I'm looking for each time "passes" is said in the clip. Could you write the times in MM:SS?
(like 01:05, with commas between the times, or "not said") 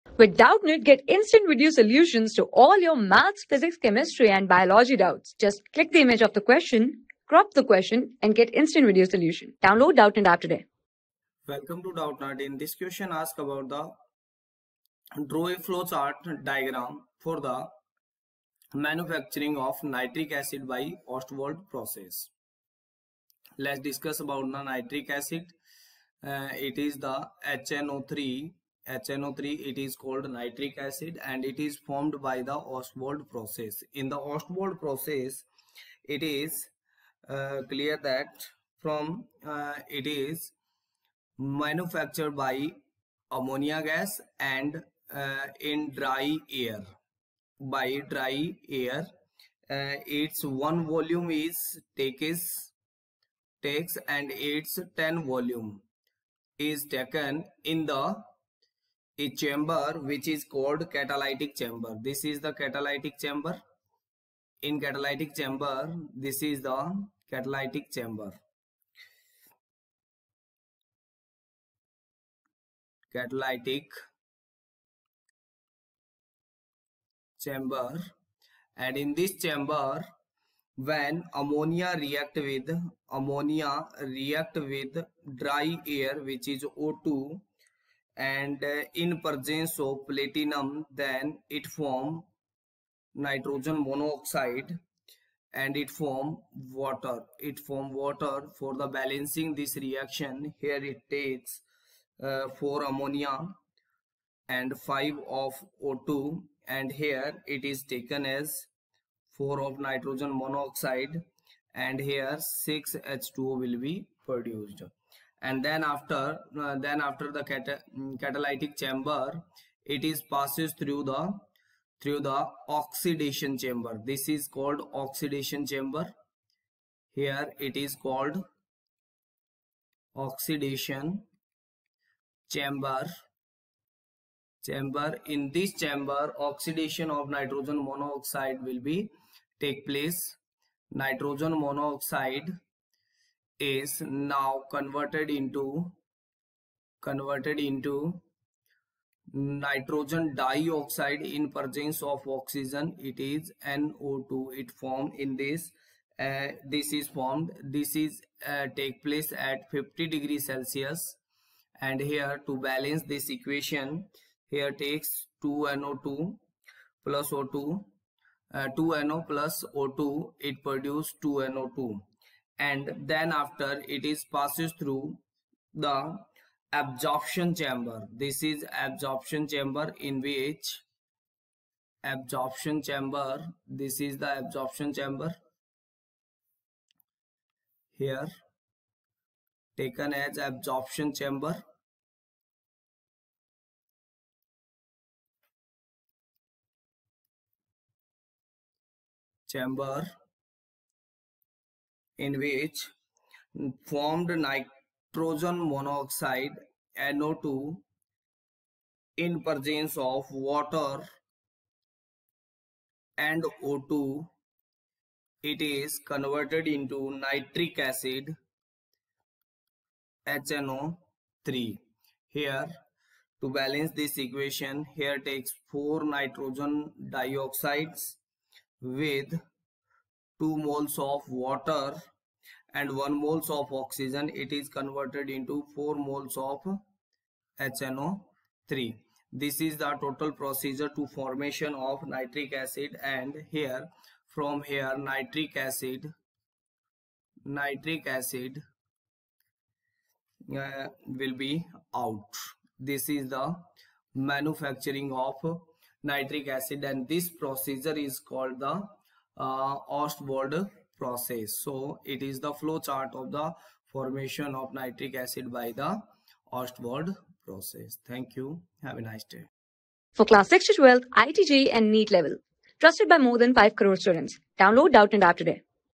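02:00, 02:54.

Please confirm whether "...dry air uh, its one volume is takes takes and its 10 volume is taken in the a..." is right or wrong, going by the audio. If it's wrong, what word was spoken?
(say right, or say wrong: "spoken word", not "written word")
right.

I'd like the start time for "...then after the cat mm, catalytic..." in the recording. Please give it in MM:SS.
01:56.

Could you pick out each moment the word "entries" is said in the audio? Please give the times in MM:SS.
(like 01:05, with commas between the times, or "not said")
not said.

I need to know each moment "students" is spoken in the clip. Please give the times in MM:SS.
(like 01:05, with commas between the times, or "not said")
04:33.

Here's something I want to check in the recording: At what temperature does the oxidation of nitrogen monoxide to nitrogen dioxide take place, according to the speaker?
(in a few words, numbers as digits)
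50 degrees Celsius.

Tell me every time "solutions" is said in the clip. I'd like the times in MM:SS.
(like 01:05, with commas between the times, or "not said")
00:01, 00:09.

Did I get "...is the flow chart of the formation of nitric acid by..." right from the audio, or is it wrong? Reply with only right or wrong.
right.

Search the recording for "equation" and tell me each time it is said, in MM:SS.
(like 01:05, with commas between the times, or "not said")
02:43, 03:44.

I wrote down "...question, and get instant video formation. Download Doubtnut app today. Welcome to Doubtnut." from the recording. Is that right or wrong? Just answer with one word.
wrong.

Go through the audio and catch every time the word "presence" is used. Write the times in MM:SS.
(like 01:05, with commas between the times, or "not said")
01:29, 02:31, 03:29.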